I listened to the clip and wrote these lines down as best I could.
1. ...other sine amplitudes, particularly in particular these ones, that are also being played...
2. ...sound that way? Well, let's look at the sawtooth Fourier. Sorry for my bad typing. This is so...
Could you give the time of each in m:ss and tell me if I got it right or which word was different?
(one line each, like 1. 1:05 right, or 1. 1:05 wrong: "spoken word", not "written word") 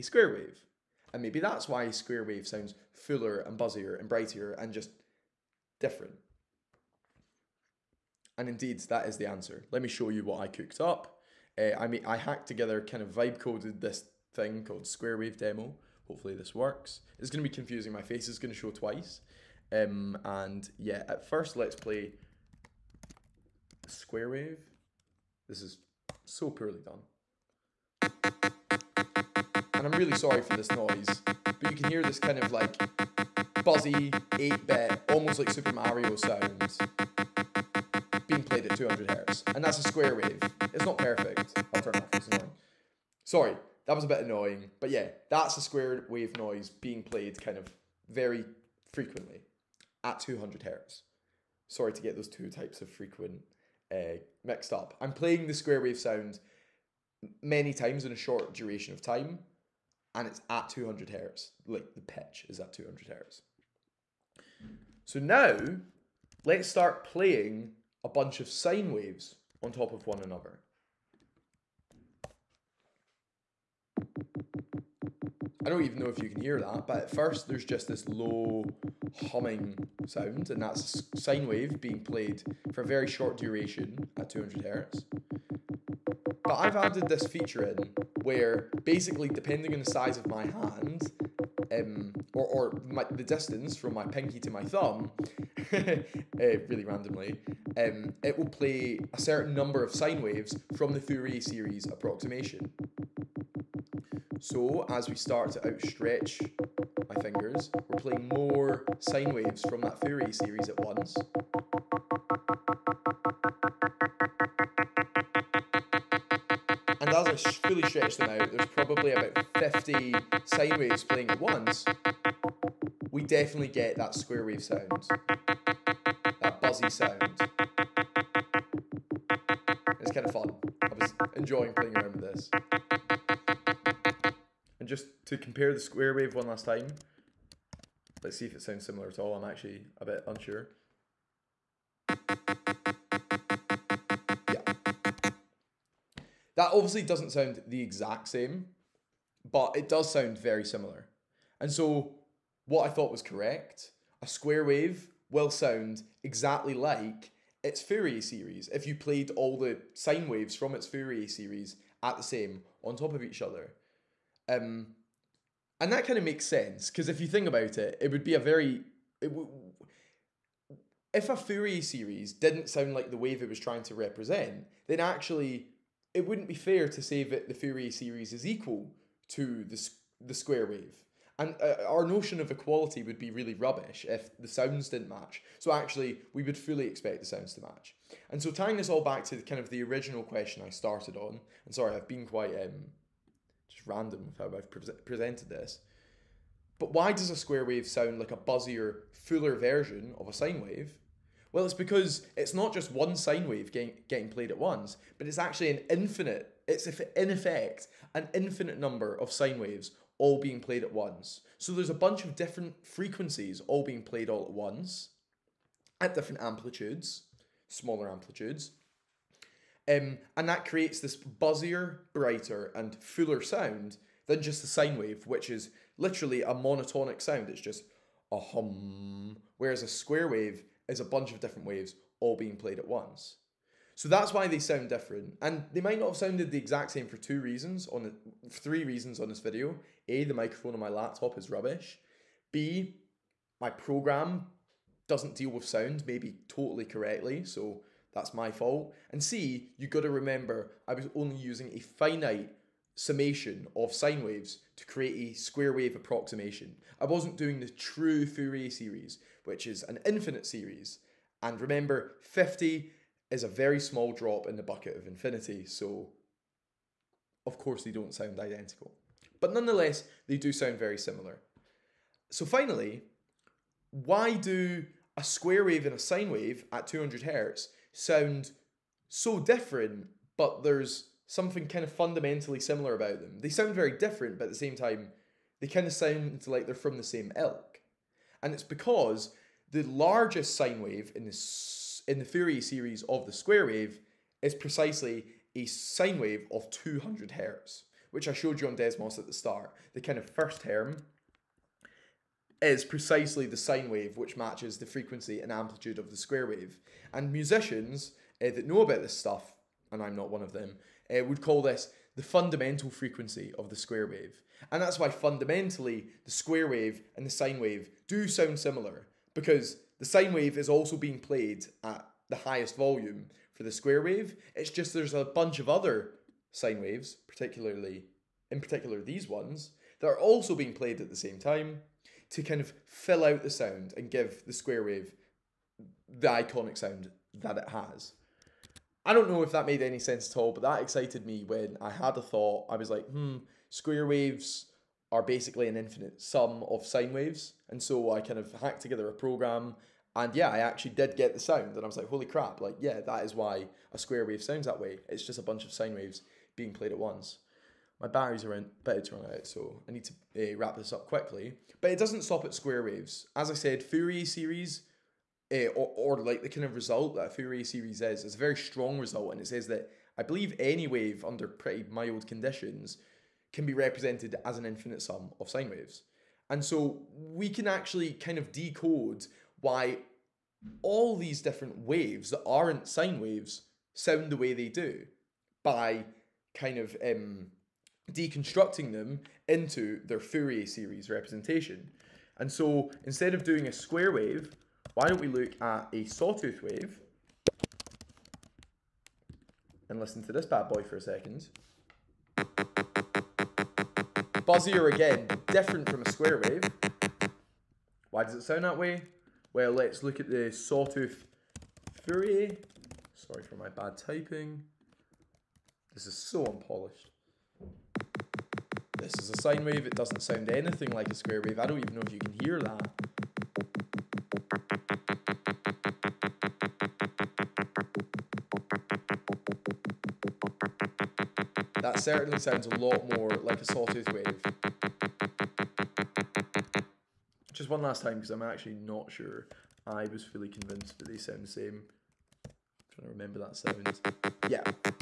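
1. 5:25 wrong: "waves", not "amplitudes"
2. 6:48 right.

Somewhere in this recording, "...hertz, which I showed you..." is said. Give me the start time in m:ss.
4:57.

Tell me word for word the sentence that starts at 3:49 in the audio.
Whereas a square wave as a bunch of different waves all being played at once.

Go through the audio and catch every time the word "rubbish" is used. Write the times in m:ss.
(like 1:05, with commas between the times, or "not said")
3:03, 4:01.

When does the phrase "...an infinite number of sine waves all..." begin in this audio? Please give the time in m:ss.
3:28.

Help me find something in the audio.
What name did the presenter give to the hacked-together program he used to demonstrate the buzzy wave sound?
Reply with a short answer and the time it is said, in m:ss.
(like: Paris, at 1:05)
Square Wave Demo, at 0:14.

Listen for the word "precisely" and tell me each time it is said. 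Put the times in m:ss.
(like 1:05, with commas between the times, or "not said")
4:54, 5:02.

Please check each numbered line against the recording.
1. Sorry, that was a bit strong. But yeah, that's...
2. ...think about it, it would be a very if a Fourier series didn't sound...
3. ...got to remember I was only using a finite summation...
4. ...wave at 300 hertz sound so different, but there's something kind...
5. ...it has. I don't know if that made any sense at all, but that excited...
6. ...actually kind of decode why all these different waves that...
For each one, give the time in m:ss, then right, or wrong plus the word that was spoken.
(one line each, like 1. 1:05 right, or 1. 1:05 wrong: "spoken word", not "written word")
1. 0:43 wrong: "annoying", not "strong"
2. 2:47 right
3. 4:09 right
4. 4:36 wrong: "200", not "300"
5. 5:37 right
6. 6:17 right.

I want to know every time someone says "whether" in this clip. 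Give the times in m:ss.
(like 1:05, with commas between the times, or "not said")
not said.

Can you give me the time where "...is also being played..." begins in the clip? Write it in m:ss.
5:20.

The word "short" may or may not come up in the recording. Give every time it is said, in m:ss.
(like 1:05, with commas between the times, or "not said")
0:58, 1:23.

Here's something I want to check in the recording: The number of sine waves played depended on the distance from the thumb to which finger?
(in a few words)
Pinky.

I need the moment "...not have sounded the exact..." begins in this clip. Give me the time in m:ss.
3:55.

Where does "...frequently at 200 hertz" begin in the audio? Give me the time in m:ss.
0:48.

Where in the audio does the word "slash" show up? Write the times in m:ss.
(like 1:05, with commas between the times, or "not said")
not said.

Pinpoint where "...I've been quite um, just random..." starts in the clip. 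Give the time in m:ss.
3:11.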